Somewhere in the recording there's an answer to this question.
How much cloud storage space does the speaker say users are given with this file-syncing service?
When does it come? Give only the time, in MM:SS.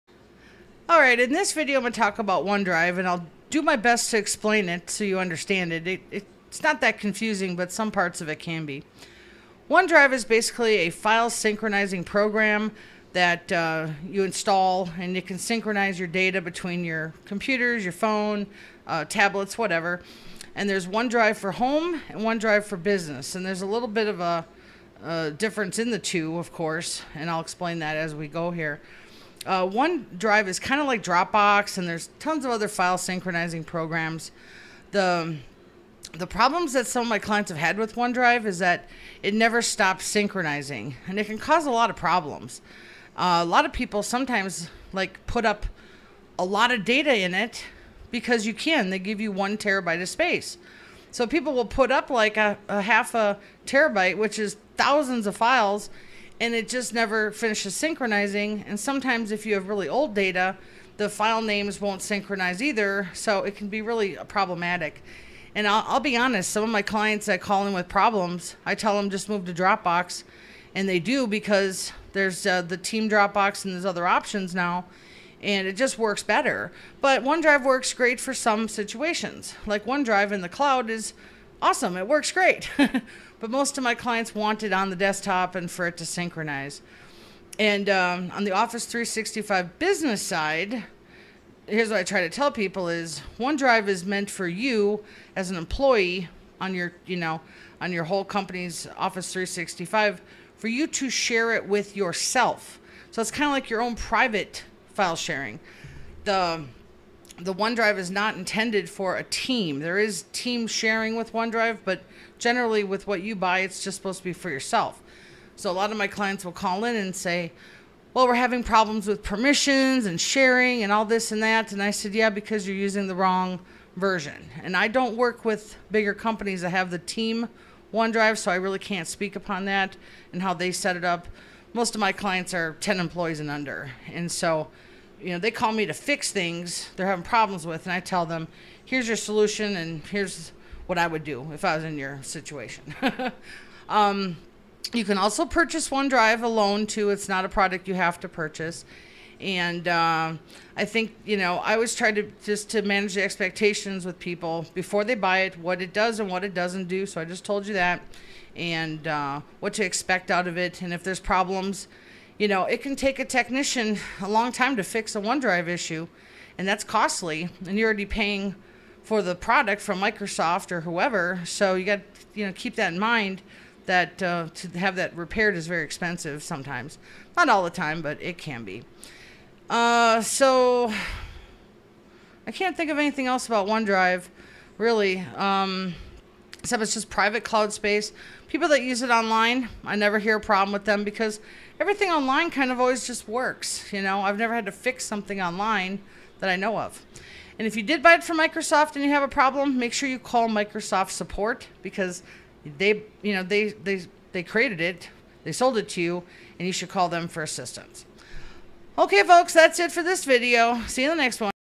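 00:49.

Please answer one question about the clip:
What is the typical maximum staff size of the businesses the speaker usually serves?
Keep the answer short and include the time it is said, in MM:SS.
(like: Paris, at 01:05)
10 employees, at 02:12.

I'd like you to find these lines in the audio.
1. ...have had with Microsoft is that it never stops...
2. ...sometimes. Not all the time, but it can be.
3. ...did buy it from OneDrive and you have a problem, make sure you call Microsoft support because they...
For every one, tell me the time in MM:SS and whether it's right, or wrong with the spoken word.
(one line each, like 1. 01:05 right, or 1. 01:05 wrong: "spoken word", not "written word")
1. 00:37 wrong: "OneDrive", not "Microsoft"
2. 02:56 right
3. 03:17 wrong: "Microsoft", not "OneDrive".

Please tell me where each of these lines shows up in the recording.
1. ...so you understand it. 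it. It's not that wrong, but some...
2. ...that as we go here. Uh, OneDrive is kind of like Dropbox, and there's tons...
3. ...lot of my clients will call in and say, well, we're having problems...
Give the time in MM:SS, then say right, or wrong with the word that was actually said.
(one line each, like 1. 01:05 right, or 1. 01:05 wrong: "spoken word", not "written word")
1. 00:04 wrong: "confusing", not "wrong"
2. 00:27 right
3. 01:55 right.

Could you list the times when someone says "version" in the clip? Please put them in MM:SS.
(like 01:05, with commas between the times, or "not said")
02:03.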